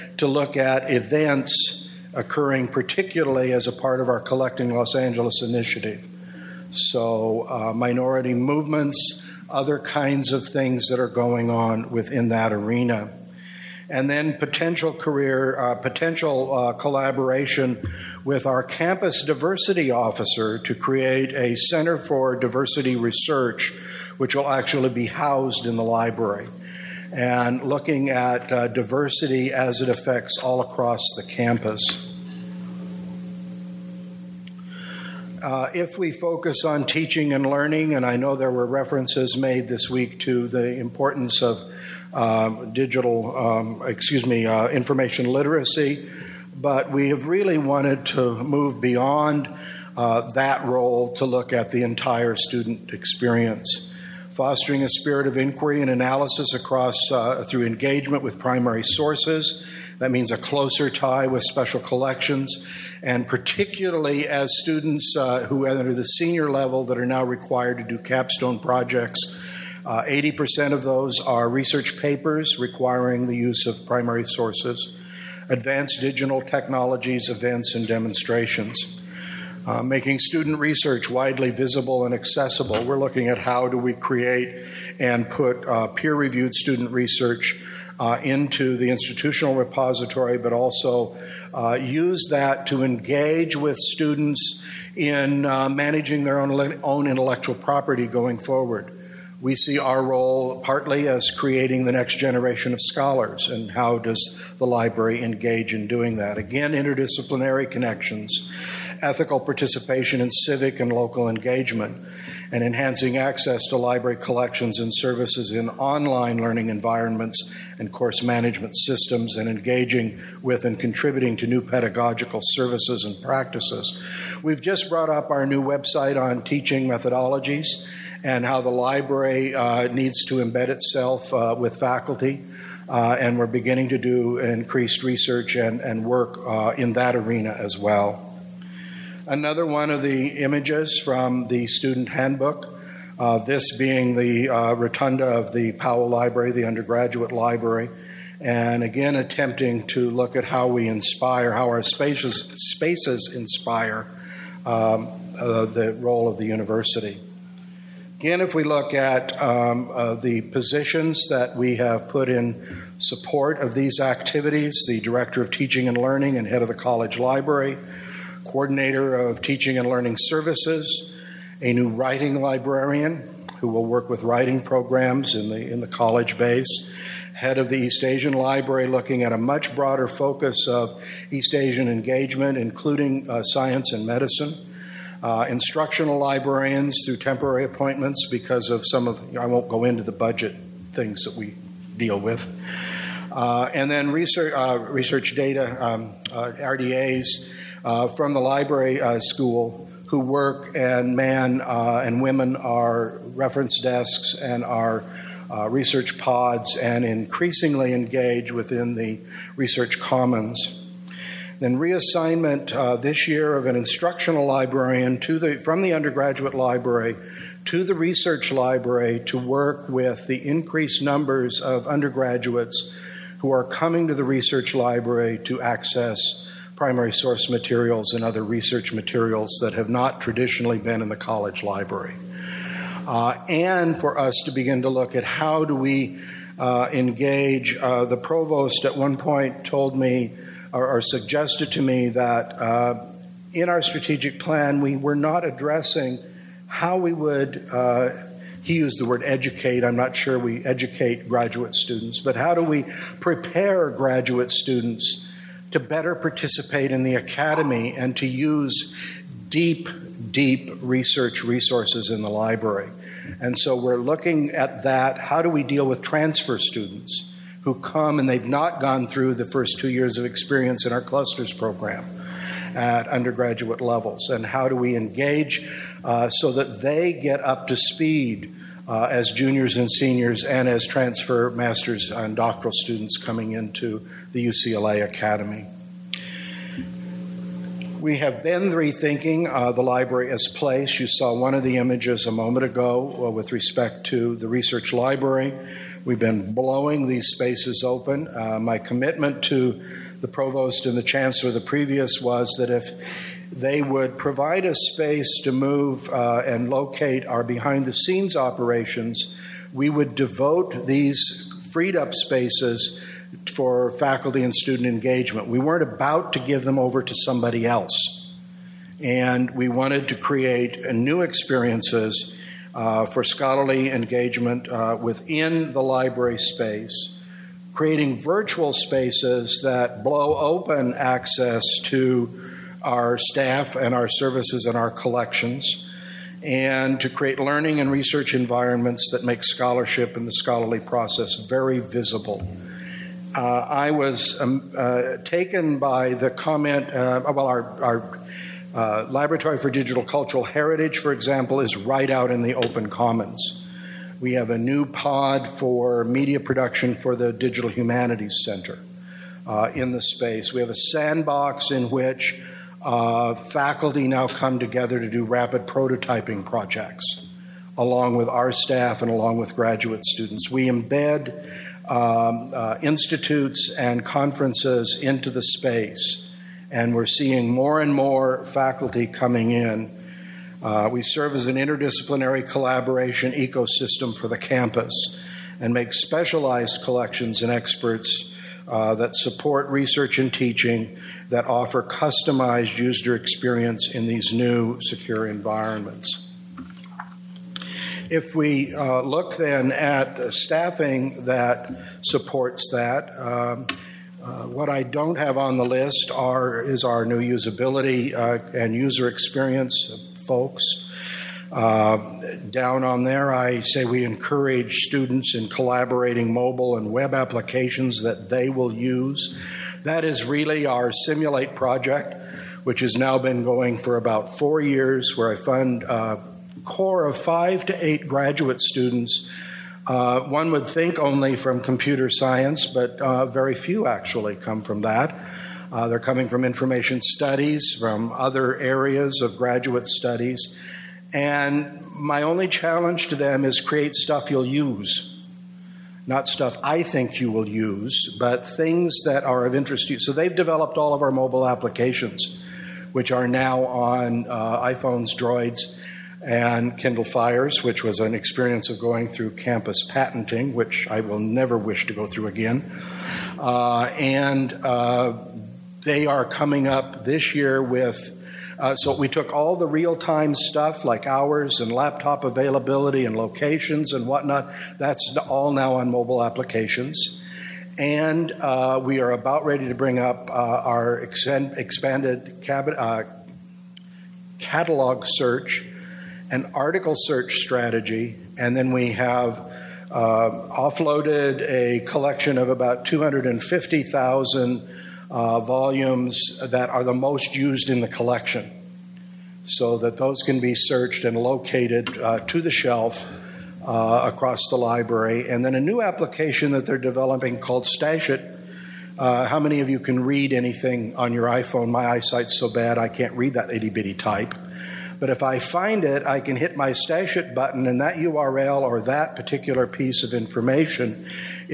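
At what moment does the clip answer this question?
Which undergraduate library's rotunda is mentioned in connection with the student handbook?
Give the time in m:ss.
2:25.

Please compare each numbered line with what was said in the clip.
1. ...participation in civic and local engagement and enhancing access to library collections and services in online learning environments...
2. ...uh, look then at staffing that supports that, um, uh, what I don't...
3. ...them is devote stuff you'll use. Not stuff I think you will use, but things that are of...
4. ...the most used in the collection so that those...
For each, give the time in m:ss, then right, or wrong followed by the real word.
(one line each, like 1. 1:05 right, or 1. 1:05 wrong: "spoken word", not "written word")
1. 1:49 right
2. 6:38 right
3. 7:23 wrong: "create", not "devote"
4. 8:16 right.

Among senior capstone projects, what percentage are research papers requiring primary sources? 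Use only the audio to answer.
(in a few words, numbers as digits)
80%.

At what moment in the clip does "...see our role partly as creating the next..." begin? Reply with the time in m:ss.
1:39.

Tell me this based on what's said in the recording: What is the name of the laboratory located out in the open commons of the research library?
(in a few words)
Laboratory for Digital Cultural Heritage.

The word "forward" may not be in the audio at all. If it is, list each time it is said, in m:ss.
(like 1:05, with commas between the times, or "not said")
1:38.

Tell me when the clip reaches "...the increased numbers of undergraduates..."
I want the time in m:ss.
3:40.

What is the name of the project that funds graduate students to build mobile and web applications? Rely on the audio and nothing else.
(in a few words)
Simulate.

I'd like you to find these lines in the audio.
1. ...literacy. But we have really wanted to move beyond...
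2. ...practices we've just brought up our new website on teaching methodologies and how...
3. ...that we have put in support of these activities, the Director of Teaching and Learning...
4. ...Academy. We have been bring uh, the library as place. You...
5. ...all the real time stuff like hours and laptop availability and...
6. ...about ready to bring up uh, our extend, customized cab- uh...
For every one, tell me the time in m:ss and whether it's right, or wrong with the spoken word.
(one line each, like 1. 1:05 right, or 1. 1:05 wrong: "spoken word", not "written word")
1. 0:45 right
2. 2:03 right
3. 2:41 right
4. 4:45 wrong: "rethinking", not "bring"
5. 7:49 right
6. 7:59 wrong: "expanded", not "customized".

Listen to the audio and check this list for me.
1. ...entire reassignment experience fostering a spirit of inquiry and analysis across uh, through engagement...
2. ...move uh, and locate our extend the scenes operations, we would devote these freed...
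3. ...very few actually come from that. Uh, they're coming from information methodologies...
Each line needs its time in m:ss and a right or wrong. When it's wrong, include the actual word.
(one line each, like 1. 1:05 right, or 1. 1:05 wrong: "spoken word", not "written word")
1. 0:51 wrong: "student", not "reassignment"
2. 5:05 wrong: "behind", not "extend"
3. 7:13 wrong: "studies", not "methodologies".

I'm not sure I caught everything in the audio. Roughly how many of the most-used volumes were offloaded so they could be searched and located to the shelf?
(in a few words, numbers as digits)
250,000.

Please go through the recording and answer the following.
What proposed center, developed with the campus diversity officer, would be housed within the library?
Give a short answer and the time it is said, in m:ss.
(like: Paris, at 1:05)
Center for Diversity Research, at 0:21.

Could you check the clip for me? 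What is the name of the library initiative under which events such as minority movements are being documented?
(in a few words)
Collecting Los Angeles.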